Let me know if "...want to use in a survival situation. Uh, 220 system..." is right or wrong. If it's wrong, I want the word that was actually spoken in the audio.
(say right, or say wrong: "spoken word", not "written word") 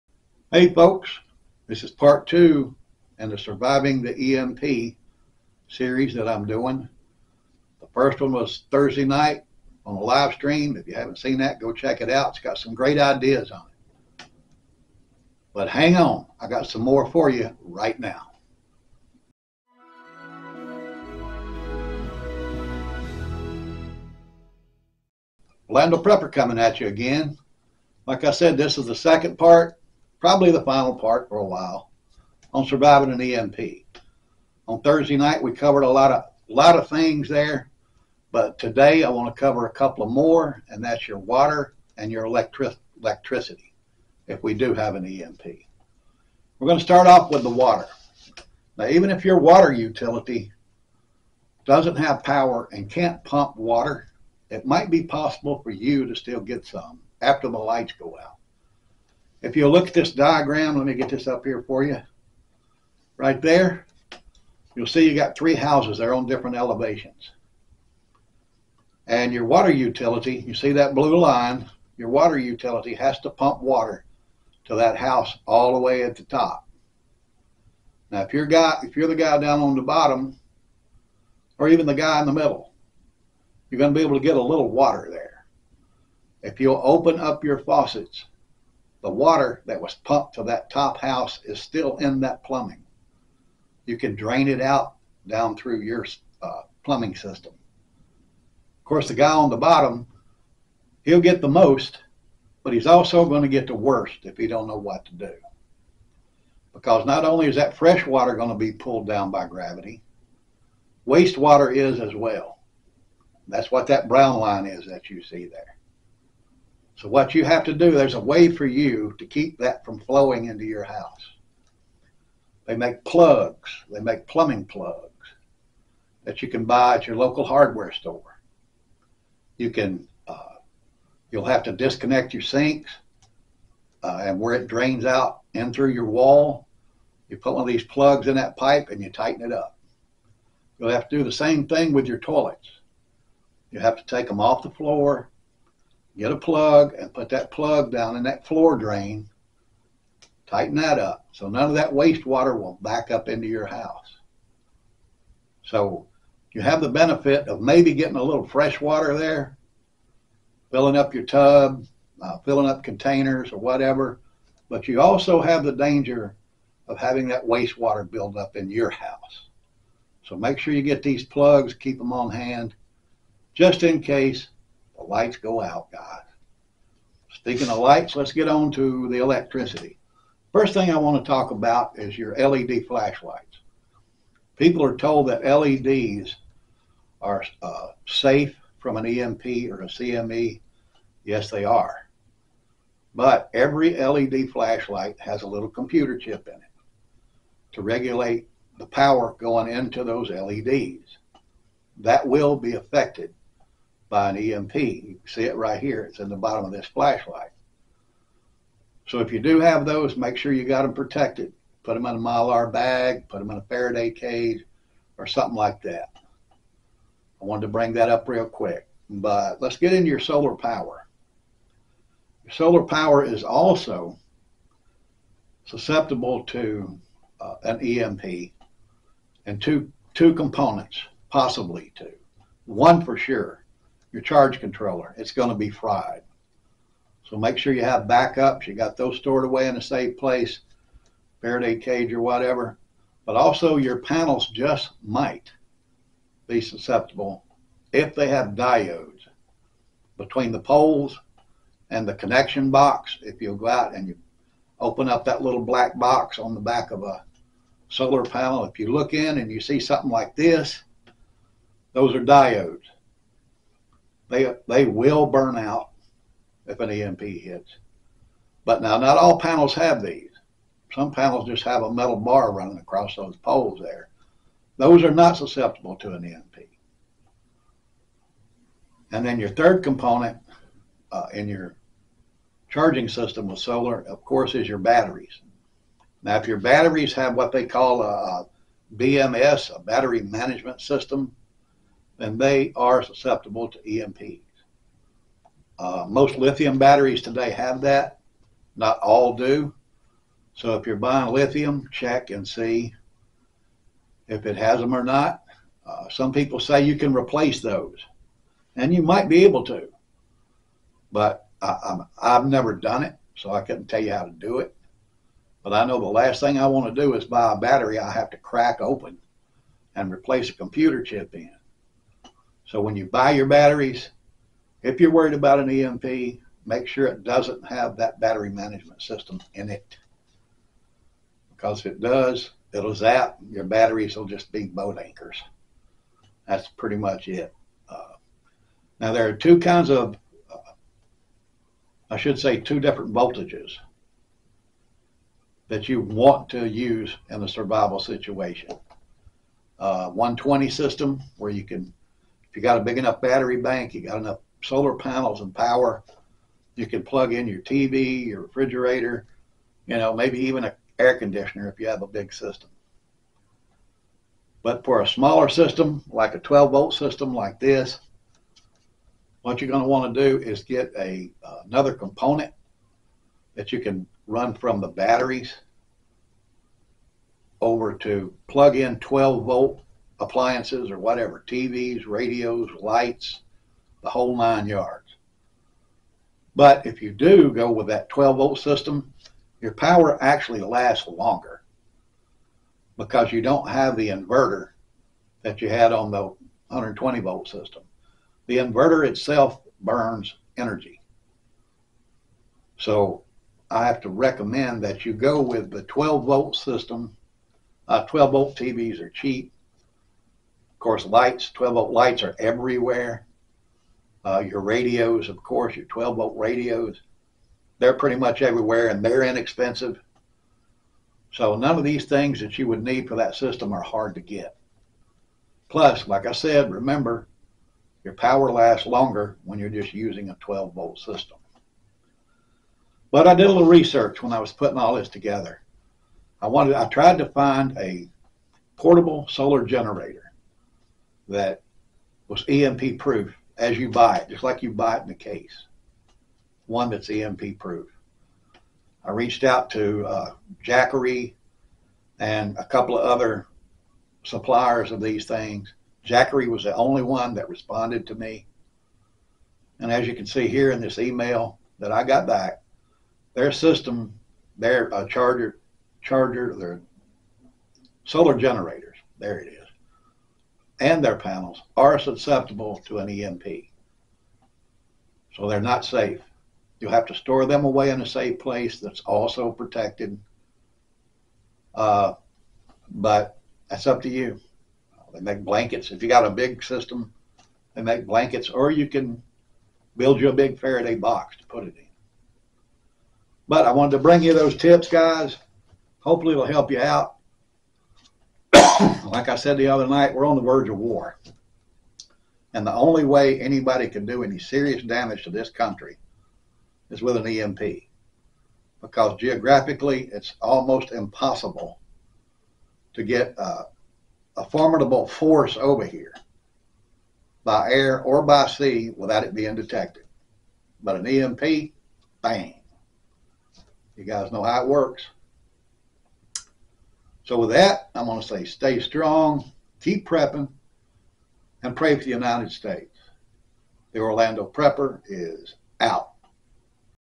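wrong: "120", not "220".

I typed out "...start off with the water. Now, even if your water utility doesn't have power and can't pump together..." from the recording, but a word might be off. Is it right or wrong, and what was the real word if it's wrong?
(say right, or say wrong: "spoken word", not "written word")
wrong: "water", not "together".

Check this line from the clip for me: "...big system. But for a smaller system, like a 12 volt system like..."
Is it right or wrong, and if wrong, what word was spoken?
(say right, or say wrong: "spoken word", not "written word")
right.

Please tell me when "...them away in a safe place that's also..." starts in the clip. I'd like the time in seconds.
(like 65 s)
477 s.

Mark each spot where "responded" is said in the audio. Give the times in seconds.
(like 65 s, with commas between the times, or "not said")
457 s.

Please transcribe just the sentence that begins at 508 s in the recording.
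Because geographically, it's almost impossible to get a, a formidable force over here by air or by sea without it being detected.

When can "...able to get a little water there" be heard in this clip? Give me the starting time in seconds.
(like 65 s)
84 s.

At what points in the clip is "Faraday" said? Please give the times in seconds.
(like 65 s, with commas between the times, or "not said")
213 s, 241 s, 490 s.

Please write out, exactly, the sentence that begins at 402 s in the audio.
So I have to recommend that you go with the 12 volt system.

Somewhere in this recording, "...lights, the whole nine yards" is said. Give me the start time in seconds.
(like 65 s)
382 s.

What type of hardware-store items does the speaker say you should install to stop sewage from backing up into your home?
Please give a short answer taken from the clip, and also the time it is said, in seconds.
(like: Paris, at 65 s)
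plumbing plugs, at 124 s.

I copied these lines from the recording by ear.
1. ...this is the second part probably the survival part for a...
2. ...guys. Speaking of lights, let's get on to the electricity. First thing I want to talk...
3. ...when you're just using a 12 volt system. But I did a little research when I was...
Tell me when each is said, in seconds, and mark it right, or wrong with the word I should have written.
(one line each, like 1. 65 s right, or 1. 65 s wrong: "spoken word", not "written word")
1. 28 s wrong: "final", not "survival"
2. 175 s right
3. 429 s right.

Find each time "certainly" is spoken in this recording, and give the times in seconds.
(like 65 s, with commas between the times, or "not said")
not said.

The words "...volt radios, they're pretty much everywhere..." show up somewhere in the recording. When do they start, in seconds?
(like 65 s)
416 s.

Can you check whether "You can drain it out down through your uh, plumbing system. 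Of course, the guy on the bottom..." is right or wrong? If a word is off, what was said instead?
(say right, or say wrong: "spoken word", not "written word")
right.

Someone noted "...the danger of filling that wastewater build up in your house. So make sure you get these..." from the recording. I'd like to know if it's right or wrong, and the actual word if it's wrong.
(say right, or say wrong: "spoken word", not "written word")
wrong: "having", not "filling".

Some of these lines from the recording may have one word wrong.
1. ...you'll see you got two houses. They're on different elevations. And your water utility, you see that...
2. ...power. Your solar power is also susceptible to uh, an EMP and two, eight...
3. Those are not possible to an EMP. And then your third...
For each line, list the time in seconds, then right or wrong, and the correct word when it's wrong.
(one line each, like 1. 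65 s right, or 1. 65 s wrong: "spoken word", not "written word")
1. 64 s wrong: "three", not "two"
2. 220 s wrong: "two", not "eight"
3. 274 s wrong: "susceptible", not "possible".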